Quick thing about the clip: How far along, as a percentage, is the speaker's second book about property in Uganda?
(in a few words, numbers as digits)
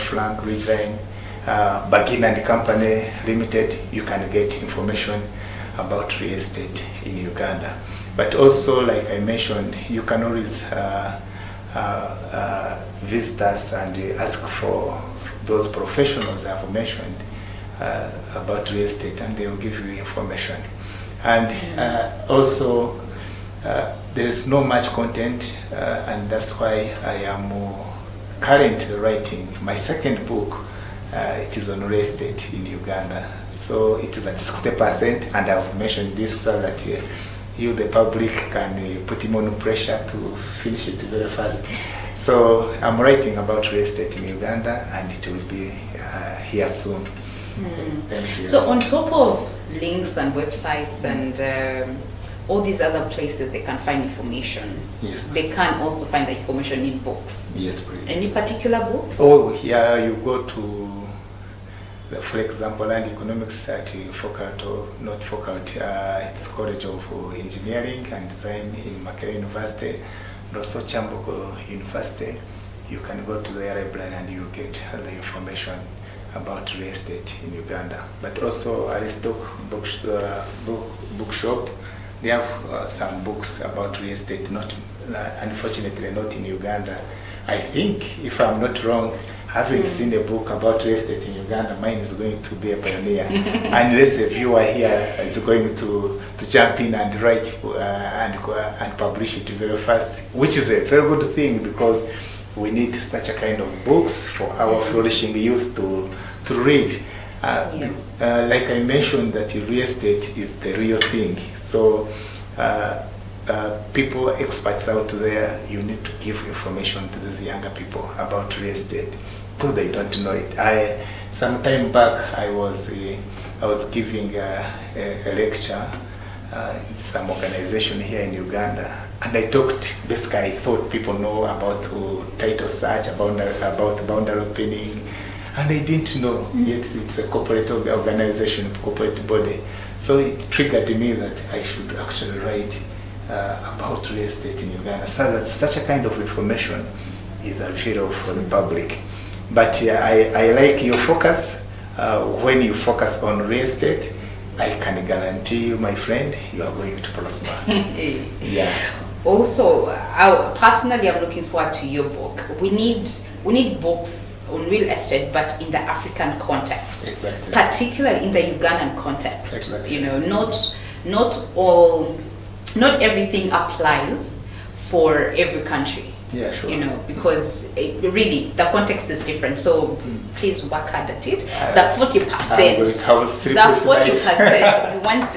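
60%.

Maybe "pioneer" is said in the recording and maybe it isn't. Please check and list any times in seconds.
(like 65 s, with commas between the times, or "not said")
92 s.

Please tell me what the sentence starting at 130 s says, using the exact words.
Basically, I thought people know about oh, title search, about about boundary opening and I didn't know mm.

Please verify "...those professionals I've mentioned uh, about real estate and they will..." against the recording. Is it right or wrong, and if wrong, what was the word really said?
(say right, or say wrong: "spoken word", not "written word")
right.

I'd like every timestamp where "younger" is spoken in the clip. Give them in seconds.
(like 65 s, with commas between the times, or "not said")
117 s.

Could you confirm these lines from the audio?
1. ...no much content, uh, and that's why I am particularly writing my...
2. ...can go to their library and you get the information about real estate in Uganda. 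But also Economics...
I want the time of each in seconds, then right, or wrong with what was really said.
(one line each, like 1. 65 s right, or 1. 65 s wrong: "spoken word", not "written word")
1. 24 s wrong: "currently", not "particularly"
2. 72 s wrong: "Aristoc", not "Economics".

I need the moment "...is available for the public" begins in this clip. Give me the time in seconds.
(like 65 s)
147 s.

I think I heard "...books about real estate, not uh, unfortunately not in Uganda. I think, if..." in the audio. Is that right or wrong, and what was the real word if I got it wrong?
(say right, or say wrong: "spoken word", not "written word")
right.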